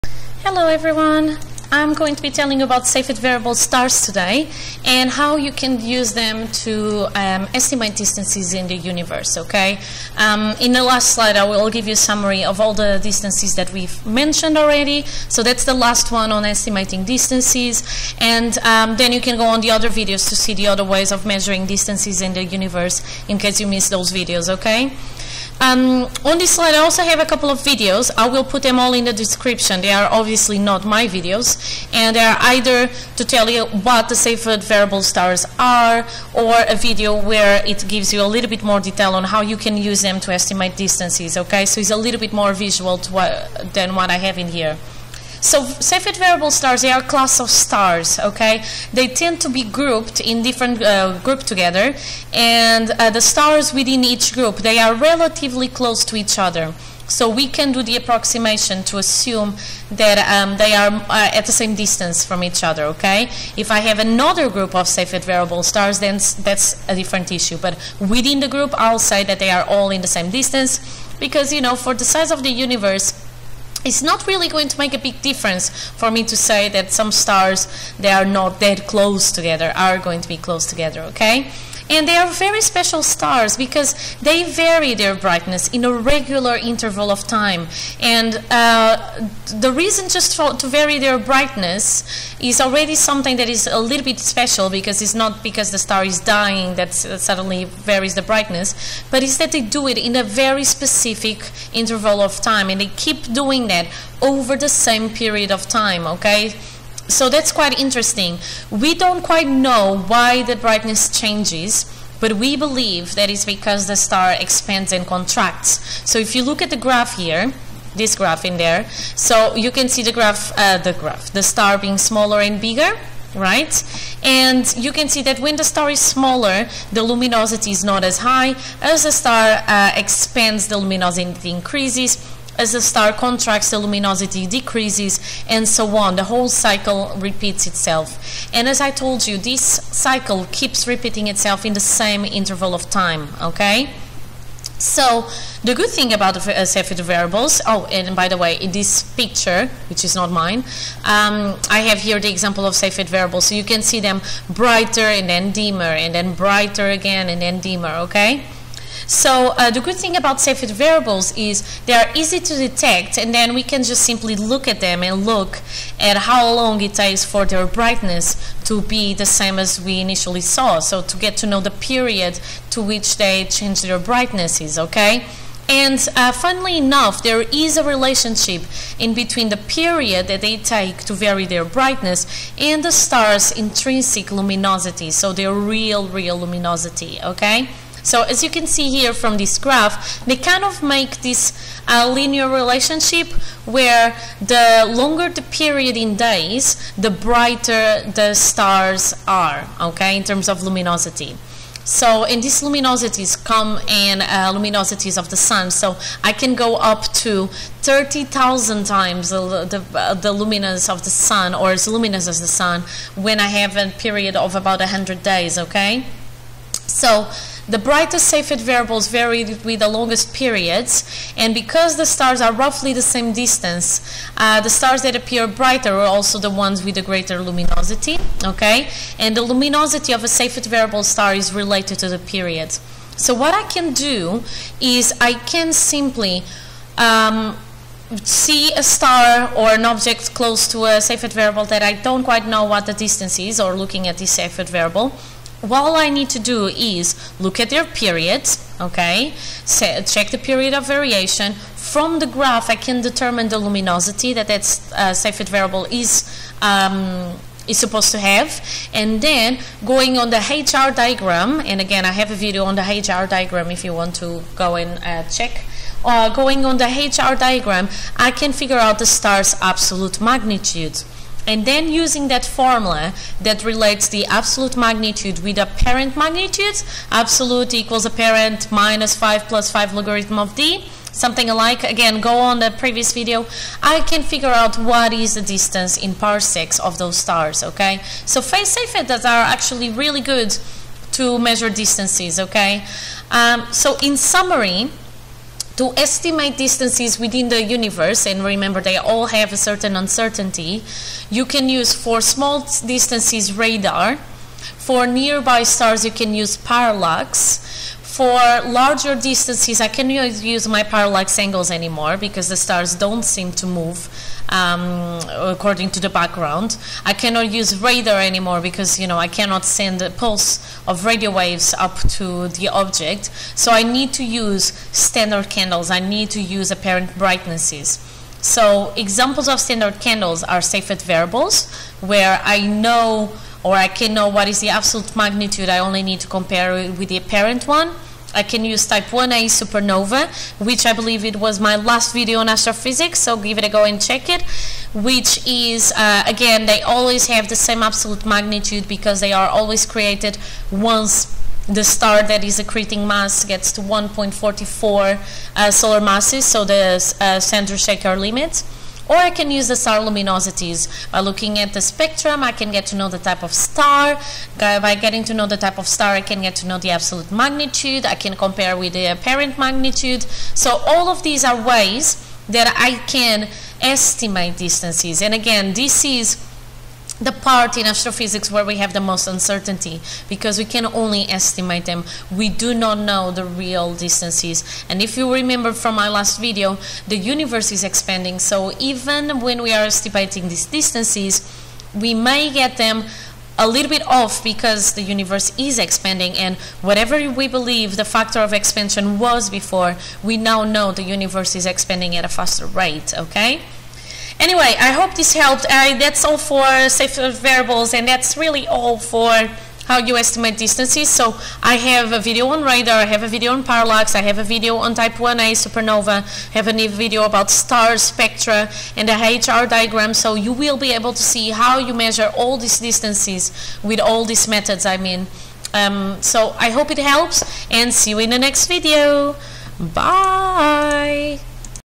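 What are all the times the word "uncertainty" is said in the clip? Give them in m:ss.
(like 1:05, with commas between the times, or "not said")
4:59, 6:19.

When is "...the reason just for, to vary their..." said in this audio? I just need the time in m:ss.
1:29.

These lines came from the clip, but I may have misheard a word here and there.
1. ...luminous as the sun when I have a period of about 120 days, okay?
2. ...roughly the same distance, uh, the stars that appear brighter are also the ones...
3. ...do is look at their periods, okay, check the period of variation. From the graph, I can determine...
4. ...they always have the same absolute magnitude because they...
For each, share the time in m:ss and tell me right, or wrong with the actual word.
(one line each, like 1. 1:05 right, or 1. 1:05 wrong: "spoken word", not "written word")
1. 3:31 wrong: "100", not "120"
2. 3:42 right
3. 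4:06 right
4. 5:46 right.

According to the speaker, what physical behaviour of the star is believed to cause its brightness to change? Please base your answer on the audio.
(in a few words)
Expands and contracts.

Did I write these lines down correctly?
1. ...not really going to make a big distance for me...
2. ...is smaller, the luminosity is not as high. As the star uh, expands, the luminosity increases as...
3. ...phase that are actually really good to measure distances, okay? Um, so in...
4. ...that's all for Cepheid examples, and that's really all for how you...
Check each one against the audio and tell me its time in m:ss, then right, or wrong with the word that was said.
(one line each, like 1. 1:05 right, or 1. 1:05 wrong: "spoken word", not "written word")
1. 1:14 wrong: "difference", not "distance"
2. 2:05 right
3. 4:48 right
4. 6:46 wrong: "variables", not "examples".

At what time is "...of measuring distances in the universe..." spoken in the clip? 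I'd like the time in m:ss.
0:21.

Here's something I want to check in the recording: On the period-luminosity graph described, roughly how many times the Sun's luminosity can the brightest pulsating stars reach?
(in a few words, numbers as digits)
30,000.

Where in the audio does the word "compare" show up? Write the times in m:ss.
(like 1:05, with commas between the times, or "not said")
5:36, 6:08.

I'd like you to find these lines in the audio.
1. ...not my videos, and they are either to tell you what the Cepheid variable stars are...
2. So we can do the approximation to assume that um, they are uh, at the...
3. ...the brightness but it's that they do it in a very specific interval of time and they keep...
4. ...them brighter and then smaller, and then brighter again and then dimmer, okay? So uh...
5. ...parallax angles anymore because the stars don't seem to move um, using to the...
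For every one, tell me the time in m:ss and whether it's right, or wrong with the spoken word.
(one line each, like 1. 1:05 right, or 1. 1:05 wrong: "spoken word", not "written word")
1. 0:30 right
2. 0:57 right
3. 1:38 right
4. 2:33 wrong: "dimmer", not "smaller"
5. 5:10 wrong: "according", not "using".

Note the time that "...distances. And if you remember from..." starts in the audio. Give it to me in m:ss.
6:23.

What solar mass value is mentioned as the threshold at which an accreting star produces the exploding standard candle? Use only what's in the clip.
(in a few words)
1.44 solar masses.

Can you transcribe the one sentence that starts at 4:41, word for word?
Again, go on the previous video.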